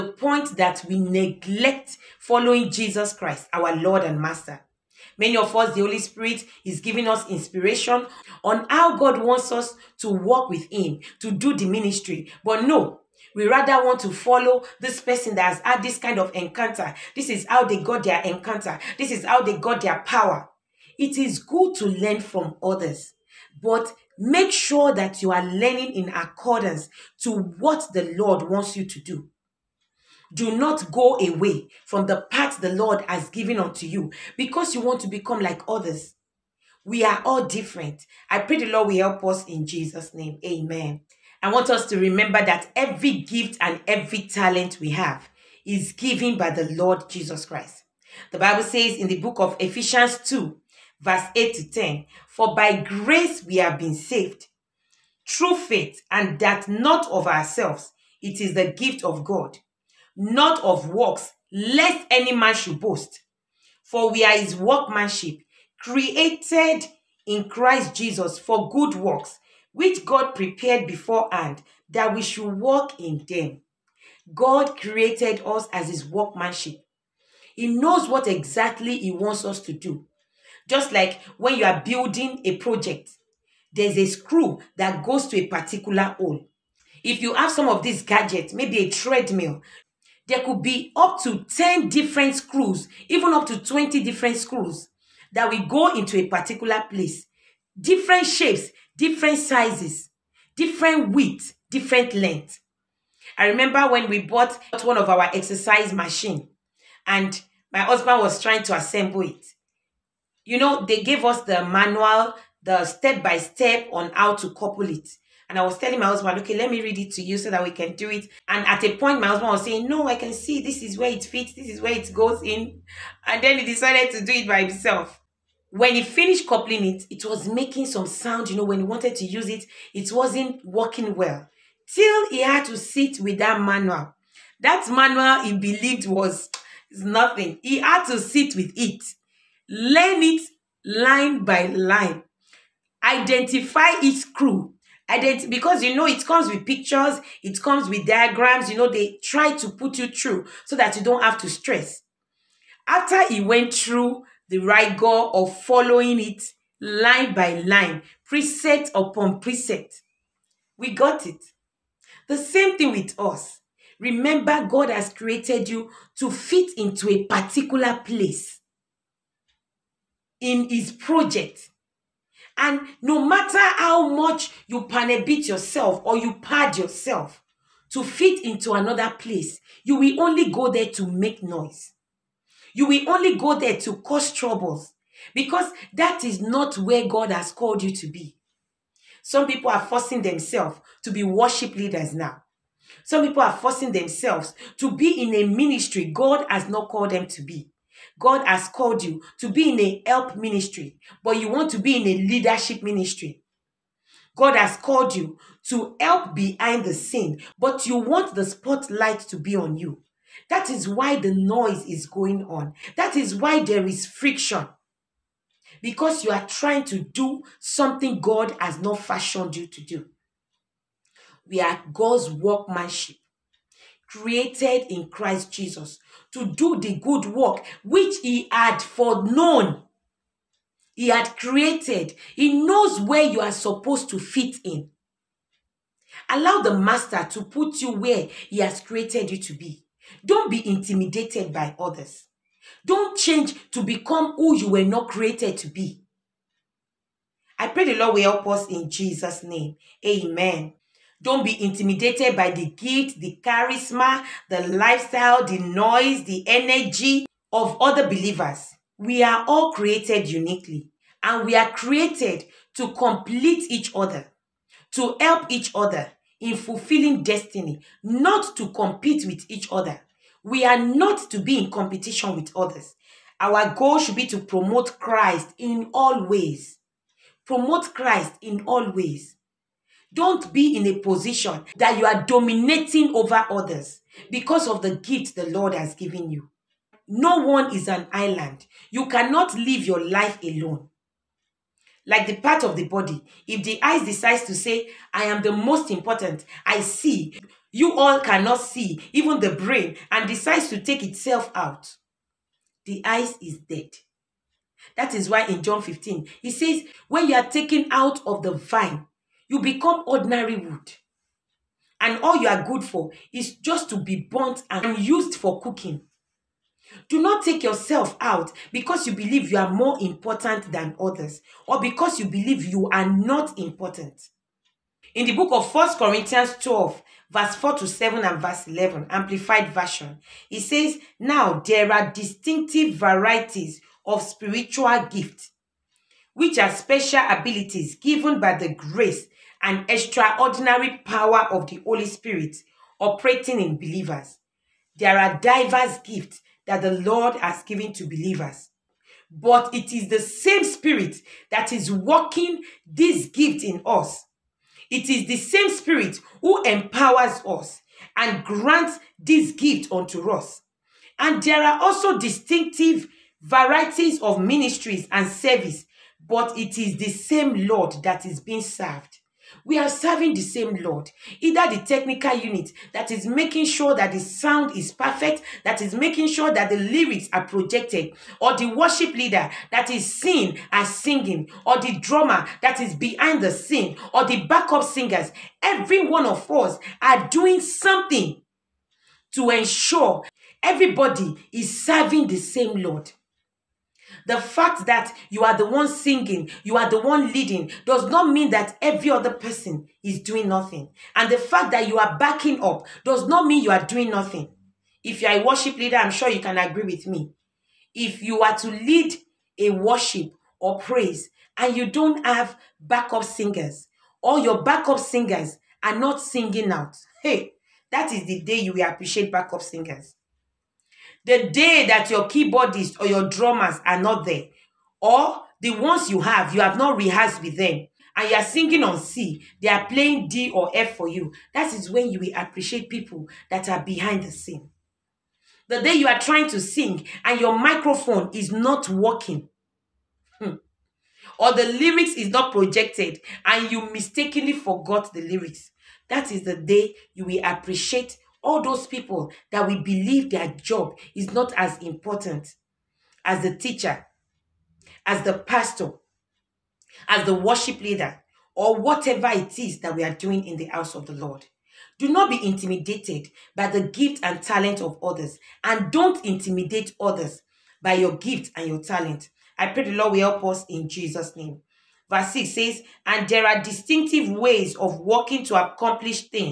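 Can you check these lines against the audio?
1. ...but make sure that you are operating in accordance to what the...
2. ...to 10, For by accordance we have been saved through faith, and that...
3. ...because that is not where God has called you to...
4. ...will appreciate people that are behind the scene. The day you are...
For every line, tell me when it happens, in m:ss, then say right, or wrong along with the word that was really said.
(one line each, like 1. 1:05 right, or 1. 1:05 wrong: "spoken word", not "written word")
1. 0:23 wrong: "learning", not "operating"
2. 0:51 wrong: "grace", not "accordance"
3. 3:05 right
4. 7:12 right.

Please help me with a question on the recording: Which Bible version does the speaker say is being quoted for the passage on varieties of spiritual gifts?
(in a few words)
Amplified Version.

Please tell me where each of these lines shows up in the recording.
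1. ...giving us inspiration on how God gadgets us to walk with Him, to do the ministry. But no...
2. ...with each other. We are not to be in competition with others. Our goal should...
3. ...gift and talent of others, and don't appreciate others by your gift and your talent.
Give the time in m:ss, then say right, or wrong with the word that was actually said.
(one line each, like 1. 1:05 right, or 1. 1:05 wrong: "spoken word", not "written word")
1. 0:06 wrong: "wants", not "gadgets"
2. 4:29 right
3. 7:43 wrong: "intimidate", not "appreciate".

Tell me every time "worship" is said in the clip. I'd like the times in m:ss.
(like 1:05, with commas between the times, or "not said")
3:11, 6:18, 6:45, 6:49, 7:37.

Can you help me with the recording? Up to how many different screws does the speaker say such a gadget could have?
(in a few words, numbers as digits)
20.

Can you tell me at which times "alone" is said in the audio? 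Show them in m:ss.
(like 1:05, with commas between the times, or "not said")
4:50.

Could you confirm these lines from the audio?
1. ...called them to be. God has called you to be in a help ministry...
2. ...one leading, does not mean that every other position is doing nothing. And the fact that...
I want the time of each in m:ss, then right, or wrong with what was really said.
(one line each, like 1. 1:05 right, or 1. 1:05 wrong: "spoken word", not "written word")
1. 3:16 right
2. 6:37 wrong: "person", not "position".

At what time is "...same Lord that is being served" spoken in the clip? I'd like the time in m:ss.
6:07.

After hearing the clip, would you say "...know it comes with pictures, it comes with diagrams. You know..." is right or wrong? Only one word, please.
right.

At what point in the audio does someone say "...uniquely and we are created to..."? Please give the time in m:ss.
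4:20.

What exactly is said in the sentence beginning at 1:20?
Just like when you are building a project, there's a screw that goes to a particular hole.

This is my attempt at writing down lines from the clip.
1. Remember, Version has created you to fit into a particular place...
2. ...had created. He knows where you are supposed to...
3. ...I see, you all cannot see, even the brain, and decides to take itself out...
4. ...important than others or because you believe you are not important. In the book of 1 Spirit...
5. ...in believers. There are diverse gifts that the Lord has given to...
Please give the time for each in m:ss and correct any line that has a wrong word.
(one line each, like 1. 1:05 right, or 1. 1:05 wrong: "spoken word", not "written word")
1. 2:43 wrong: "God", not "Version"
2. 3:51 right
3. 4:56 right
4. 5:20 wrong: "Corinthians", not "Spirit"
5. 5:43 right.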